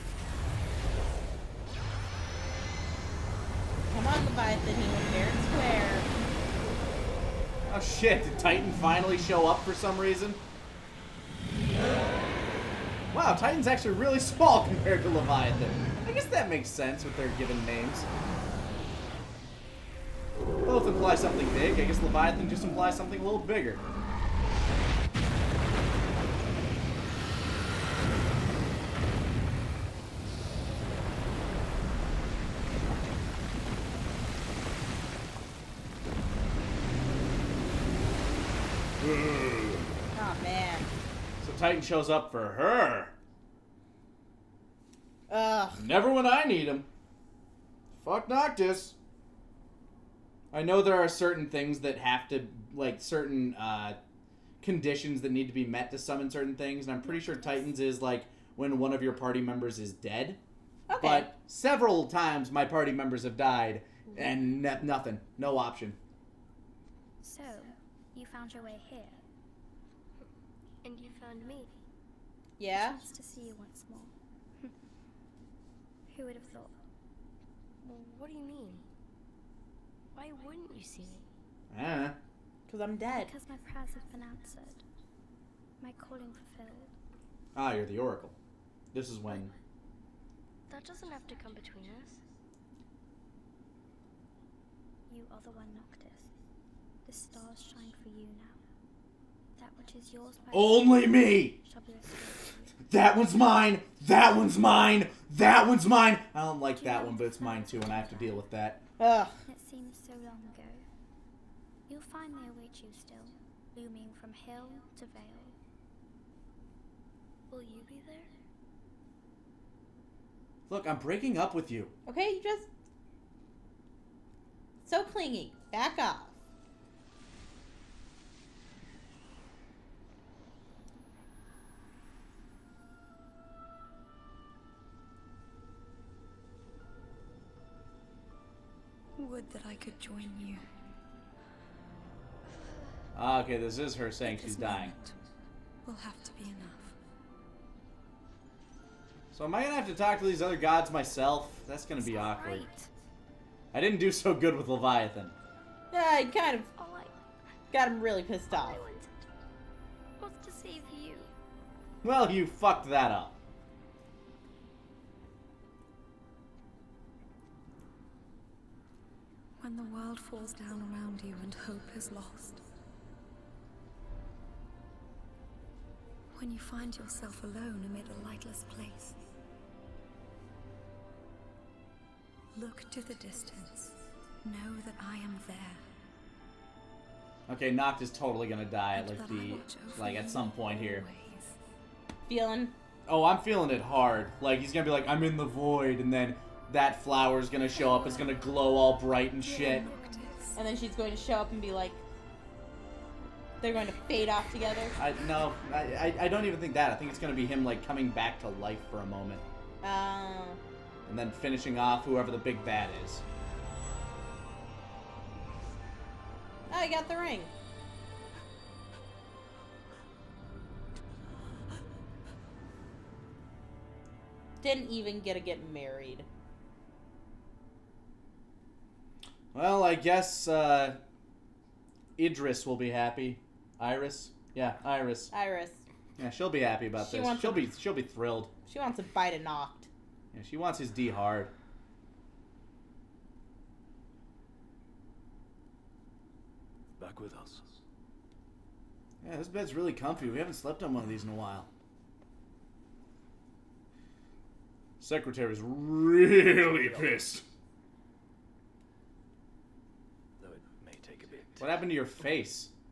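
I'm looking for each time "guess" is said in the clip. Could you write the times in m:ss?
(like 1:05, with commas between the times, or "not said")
0:16, 0:21, 3:49.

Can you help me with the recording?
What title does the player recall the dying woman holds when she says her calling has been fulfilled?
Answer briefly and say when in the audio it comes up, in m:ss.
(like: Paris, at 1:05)
the Oracle, at 1:27.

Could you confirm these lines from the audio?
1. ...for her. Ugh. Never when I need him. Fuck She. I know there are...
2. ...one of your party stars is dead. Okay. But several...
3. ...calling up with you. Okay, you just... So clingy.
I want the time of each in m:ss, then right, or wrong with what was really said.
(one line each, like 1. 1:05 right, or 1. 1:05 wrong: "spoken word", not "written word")
1. 0:42 wrong: "Noctis", not "She"
2. 0:58 wrong: "members", not "stars"
3. 2:00 wrong: "breaking", not "calling".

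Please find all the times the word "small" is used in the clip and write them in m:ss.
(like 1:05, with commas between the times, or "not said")
0:14.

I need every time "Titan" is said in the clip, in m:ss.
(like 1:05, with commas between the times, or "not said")
0:08, 0:13, 0:57.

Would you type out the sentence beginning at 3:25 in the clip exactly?
I, no, I, I, I don't even think that.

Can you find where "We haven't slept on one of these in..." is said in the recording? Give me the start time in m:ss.
4:10.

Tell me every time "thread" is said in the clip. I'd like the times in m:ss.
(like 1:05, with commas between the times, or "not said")
not said.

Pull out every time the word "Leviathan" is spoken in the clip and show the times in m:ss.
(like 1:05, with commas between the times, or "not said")
0:04, 0:15, 0:22, 2:34.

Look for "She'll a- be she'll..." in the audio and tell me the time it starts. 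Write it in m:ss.
3:57.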